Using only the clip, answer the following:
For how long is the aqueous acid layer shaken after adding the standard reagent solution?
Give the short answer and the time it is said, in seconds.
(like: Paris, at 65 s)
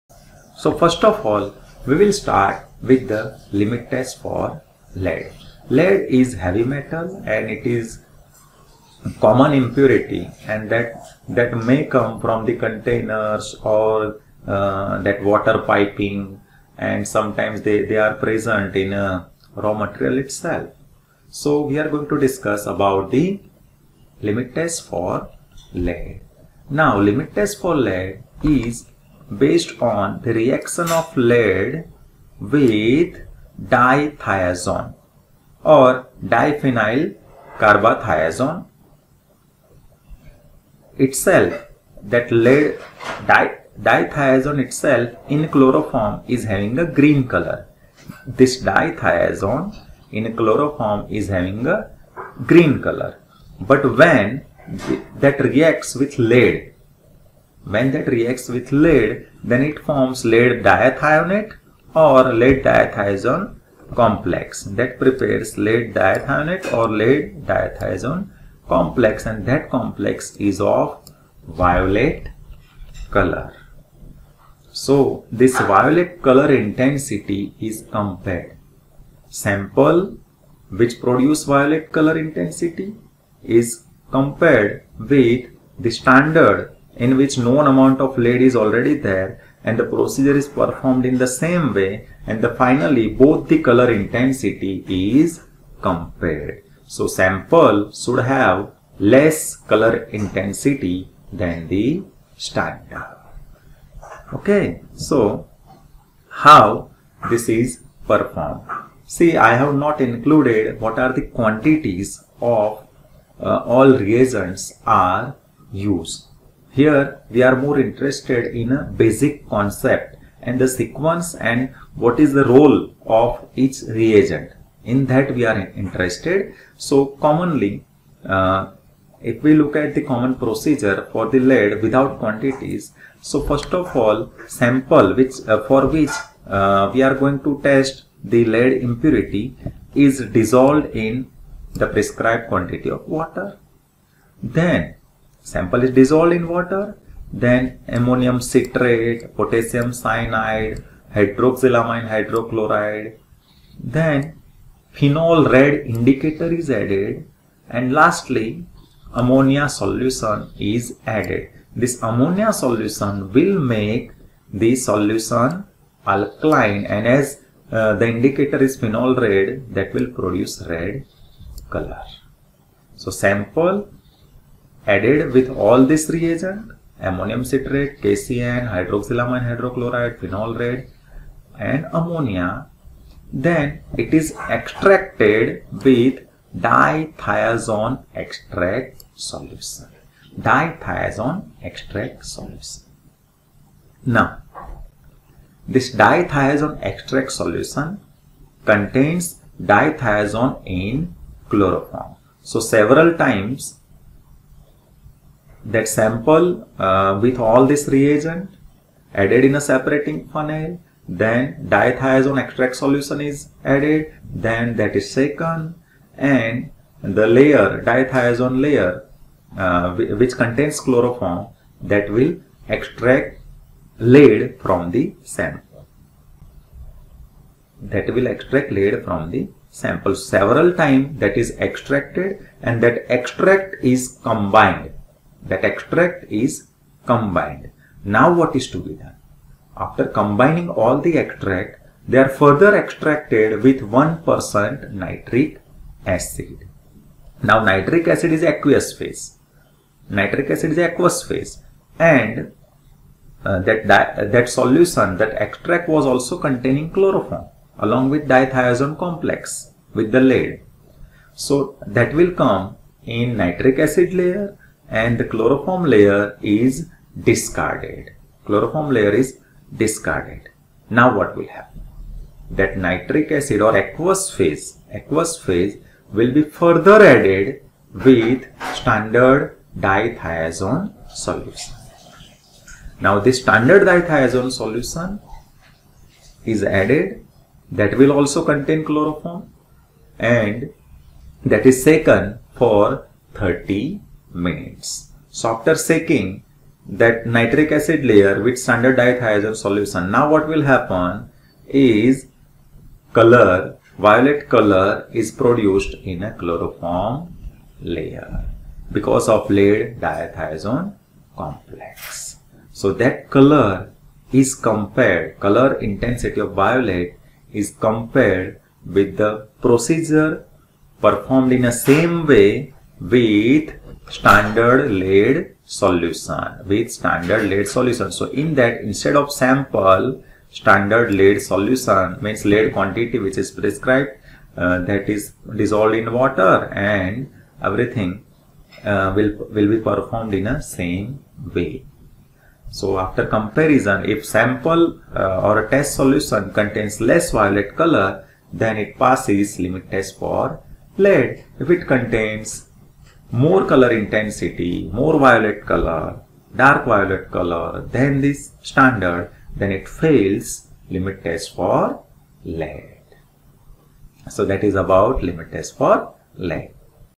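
30 minutes, at 293 s.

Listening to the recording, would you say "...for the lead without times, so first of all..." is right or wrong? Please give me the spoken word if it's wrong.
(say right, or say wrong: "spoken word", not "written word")
wrong: "quantities", not "times".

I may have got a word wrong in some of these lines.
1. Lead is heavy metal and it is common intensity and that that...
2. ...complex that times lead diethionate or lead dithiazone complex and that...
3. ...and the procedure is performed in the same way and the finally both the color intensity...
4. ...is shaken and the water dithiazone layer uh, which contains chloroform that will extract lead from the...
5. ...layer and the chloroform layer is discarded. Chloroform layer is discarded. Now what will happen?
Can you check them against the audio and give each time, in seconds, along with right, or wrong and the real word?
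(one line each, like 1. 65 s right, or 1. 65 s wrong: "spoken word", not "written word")
1. 5 s wrong: "impurity", not "intensity"
2. 63 s wrong: "prepares", not "times"
3. 89 s right
4. 214 s wrong: "layer", not "water"
5. 264 s right.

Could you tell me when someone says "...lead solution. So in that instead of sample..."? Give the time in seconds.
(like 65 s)
327 s.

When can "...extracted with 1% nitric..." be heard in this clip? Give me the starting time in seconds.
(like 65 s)
242 s.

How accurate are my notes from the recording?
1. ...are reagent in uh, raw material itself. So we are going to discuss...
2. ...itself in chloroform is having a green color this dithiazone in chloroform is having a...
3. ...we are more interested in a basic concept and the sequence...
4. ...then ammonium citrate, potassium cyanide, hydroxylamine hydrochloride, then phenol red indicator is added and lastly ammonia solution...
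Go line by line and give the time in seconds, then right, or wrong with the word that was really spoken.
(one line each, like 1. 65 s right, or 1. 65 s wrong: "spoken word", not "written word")
1. 17 s wrong: "present", not "reagent"
2. 44 s right
3. 117 s right
4. 147 s right.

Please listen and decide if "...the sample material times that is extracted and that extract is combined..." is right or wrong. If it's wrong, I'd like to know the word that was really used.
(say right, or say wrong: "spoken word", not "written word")
wrong: "several", not "material".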